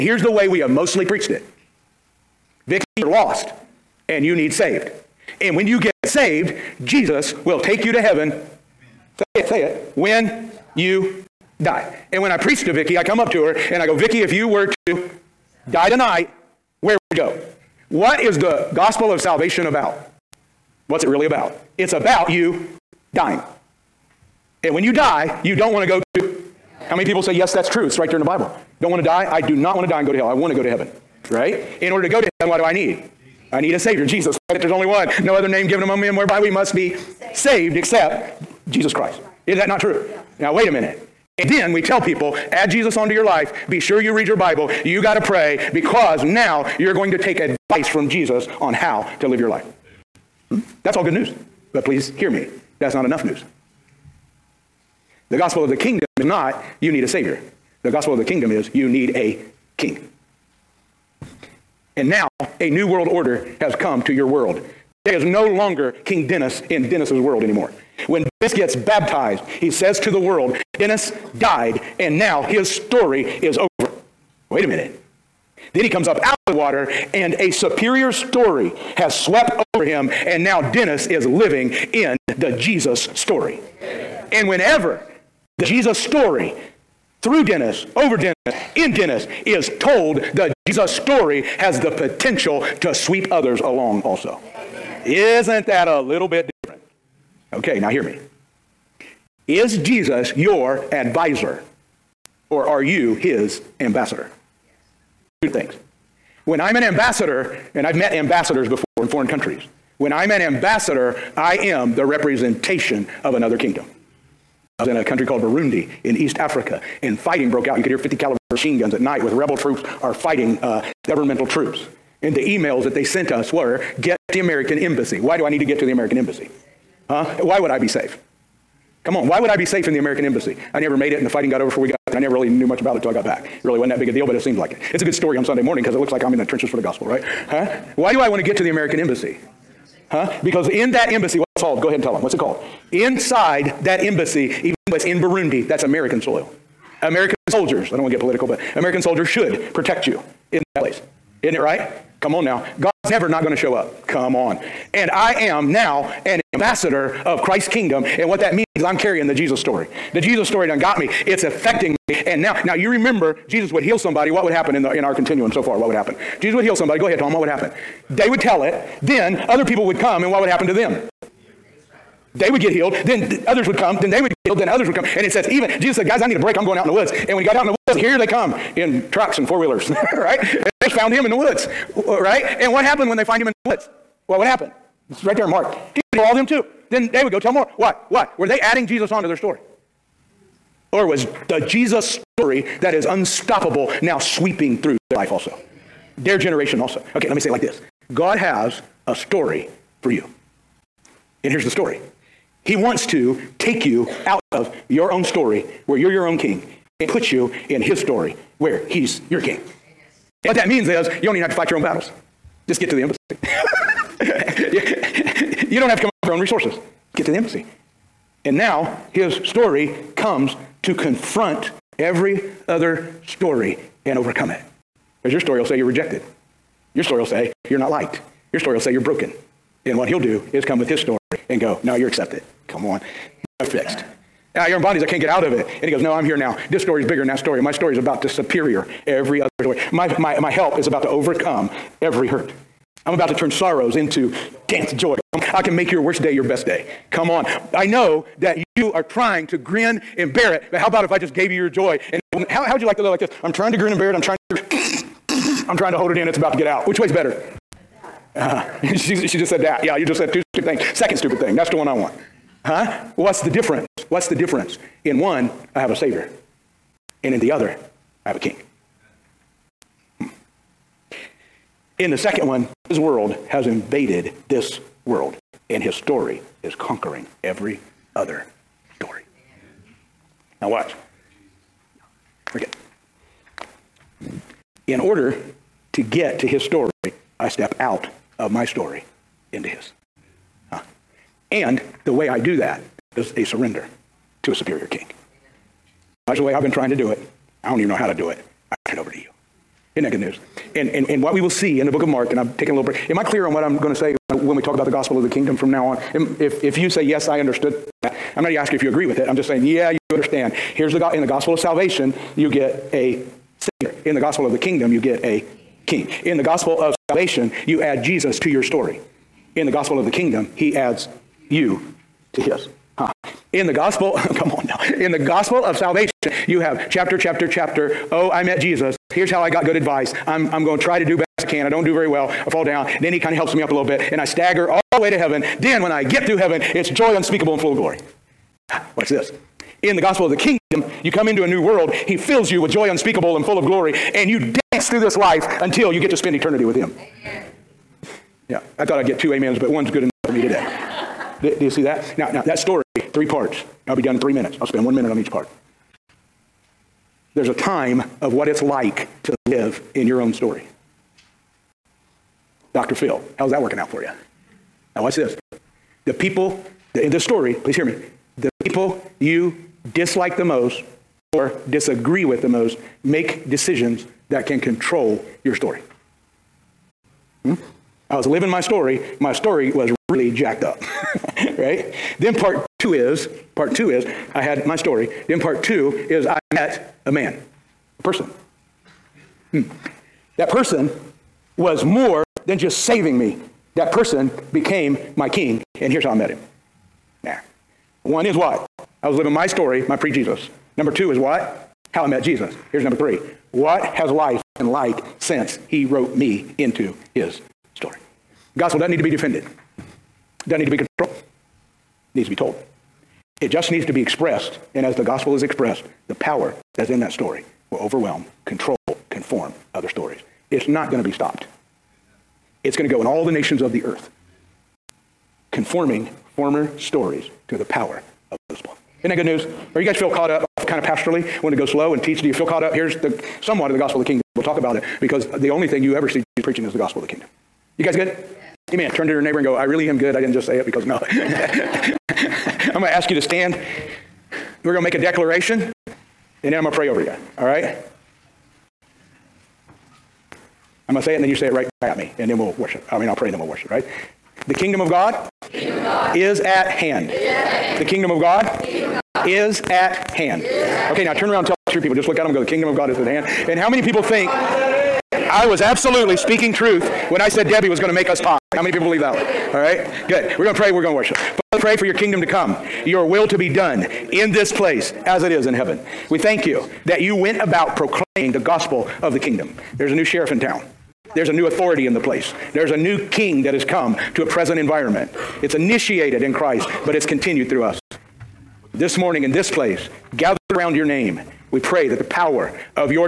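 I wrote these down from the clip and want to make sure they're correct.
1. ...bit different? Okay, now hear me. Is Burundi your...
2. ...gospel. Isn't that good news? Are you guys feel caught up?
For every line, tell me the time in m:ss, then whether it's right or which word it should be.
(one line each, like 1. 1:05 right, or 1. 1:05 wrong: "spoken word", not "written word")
1. 1:36 wrong: "Jesus", not "Burundi"
2. 7:08 right.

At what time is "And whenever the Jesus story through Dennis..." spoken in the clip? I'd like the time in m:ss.
1:24.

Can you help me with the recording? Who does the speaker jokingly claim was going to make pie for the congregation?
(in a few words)
Debbie.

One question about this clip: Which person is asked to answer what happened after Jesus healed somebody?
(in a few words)
Tom.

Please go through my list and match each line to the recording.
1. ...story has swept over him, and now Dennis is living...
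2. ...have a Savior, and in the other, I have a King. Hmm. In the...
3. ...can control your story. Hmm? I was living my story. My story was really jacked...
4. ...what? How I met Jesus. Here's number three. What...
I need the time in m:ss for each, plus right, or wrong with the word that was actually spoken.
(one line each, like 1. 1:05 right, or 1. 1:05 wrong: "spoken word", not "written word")
1. 1:18 right
2. 4:25 right
3. 6:14 right
4. 6:41 right.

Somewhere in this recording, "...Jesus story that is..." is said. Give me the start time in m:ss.
3:11.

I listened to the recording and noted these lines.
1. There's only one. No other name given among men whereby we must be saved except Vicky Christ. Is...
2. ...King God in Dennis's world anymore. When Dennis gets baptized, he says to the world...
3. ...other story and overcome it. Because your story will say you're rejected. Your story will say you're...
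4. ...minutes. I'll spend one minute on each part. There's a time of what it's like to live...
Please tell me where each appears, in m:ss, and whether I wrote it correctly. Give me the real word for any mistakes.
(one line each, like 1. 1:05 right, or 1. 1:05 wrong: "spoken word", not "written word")
1. 0:34 wrong: "Jesus", not "Vicky"
2. 1:06 wrong: "Dennis", not "God"
3. 3:42 right
4. 5:54 right.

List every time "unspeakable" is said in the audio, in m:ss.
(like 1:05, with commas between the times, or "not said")
5:37, 5:42.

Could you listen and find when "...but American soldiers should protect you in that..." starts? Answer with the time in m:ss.
2:28.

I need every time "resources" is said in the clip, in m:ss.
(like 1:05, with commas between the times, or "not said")
3:36.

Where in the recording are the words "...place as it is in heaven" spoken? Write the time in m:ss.
7:54.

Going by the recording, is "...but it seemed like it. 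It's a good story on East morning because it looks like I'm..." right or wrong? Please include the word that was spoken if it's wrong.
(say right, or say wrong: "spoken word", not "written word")
wrong: "Sunday", not "East".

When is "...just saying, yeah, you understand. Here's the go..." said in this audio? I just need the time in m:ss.
5:09.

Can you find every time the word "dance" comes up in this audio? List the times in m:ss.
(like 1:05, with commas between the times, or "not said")
4:04, 5:44.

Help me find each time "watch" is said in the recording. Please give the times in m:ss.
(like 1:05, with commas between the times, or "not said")
4:40, 5:38, 6:05.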